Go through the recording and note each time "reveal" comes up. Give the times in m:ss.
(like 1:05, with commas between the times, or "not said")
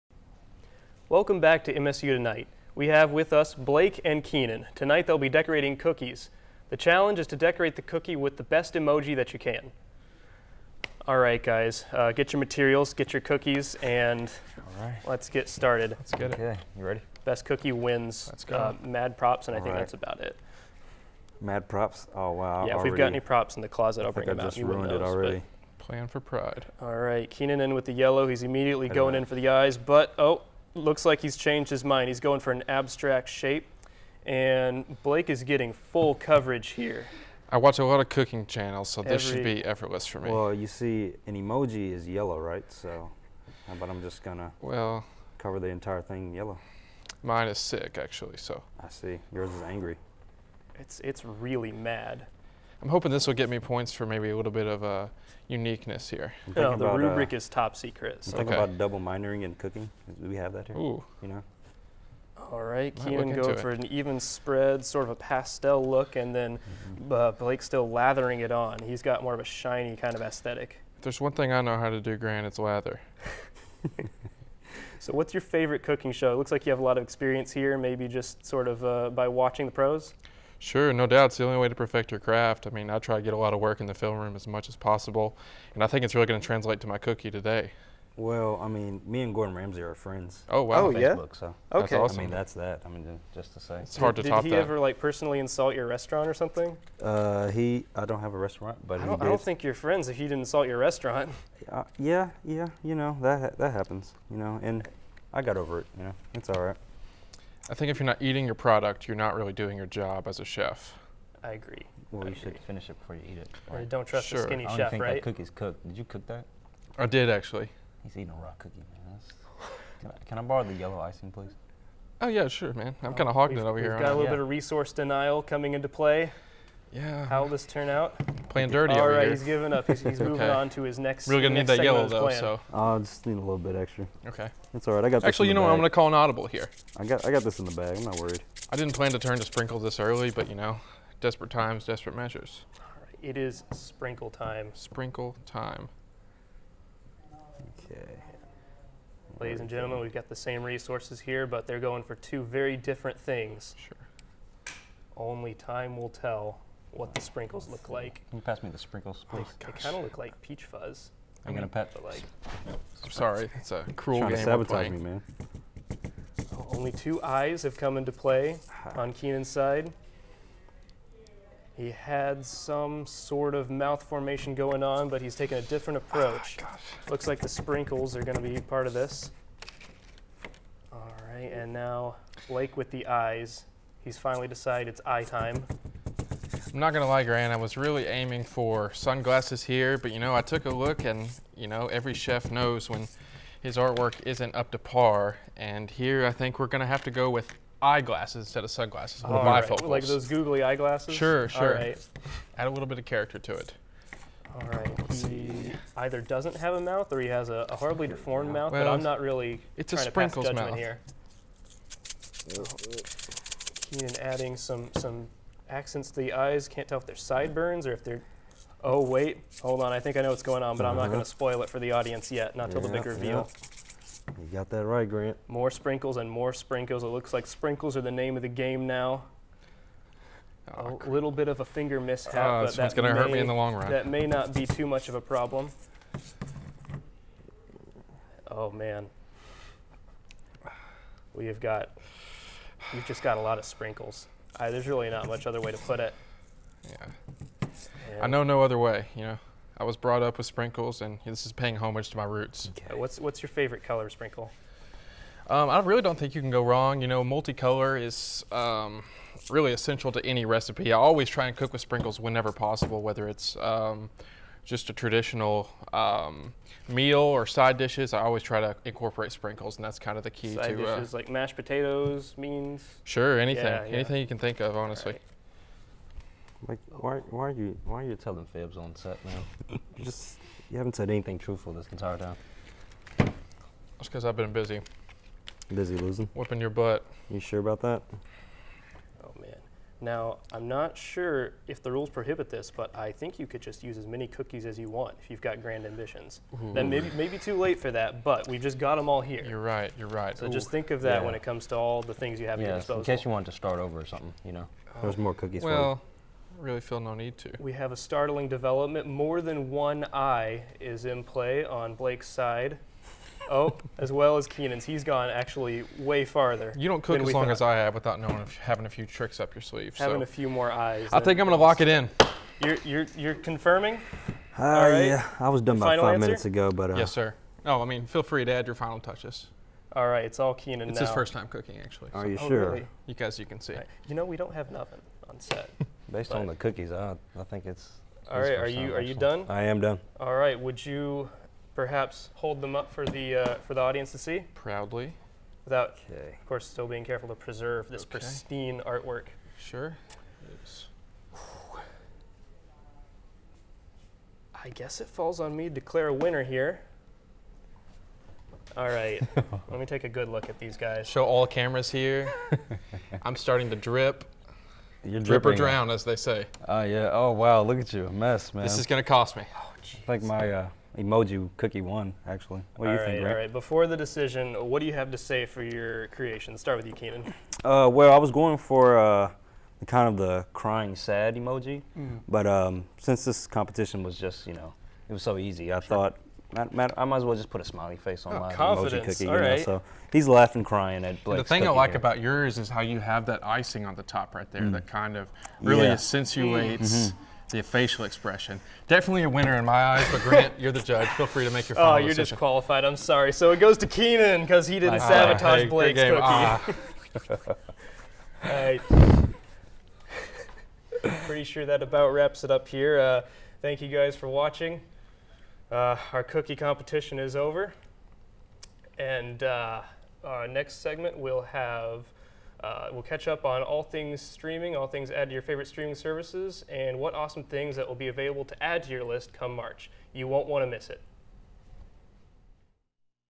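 3:43.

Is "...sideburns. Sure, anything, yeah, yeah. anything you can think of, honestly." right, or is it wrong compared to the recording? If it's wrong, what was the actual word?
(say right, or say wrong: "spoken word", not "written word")
wrong: "beans", not "sideburns".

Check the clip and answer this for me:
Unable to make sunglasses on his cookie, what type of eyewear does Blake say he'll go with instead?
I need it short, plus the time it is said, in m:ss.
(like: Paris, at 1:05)
bifocals, at 3:19.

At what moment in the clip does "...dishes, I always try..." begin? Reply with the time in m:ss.
4:27.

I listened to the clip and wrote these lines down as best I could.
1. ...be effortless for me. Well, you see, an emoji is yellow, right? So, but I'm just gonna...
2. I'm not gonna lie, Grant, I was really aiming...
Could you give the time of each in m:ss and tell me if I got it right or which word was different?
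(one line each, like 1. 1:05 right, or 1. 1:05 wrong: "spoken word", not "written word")
1. 0:39 right
2. 3:06 right.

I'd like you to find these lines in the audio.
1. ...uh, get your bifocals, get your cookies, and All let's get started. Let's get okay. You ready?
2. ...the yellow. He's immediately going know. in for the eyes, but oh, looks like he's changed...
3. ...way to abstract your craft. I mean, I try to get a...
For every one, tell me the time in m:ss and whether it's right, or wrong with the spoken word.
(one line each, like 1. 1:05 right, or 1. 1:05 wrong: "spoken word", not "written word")
1. 0:11 wrong: "materials", not "bifocals"
2. 0:27 right
3. 1:21 wrong: "perfect", not "abstract".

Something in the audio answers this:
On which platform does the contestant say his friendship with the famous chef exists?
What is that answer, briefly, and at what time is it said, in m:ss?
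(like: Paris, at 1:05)
Facebook, at 1:30.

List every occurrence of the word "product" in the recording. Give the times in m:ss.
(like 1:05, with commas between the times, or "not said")
1:48.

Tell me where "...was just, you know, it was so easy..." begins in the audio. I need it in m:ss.
6:24.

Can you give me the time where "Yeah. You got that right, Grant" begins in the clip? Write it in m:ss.
3:43.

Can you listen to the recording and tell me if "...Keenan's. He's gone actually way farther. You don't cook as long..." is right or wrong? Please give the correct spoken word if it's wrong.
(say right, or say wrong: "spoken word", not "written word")
right.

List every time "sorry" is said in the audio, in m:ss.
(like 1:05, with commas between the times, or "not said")
2:43, 6:42.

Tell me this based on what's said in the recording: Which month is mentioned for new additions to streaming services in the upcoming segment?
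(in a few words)
March.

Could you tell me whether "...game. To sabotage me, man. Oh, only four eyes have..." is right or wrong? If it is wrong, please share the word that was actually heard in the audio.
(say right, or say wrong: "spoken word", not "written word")
wrong: "two", not "four".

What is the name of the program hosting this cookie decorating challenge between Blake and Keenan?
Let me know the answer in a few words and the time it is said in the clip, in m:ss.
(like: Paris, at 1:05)
MSU Tonight, at 0:01.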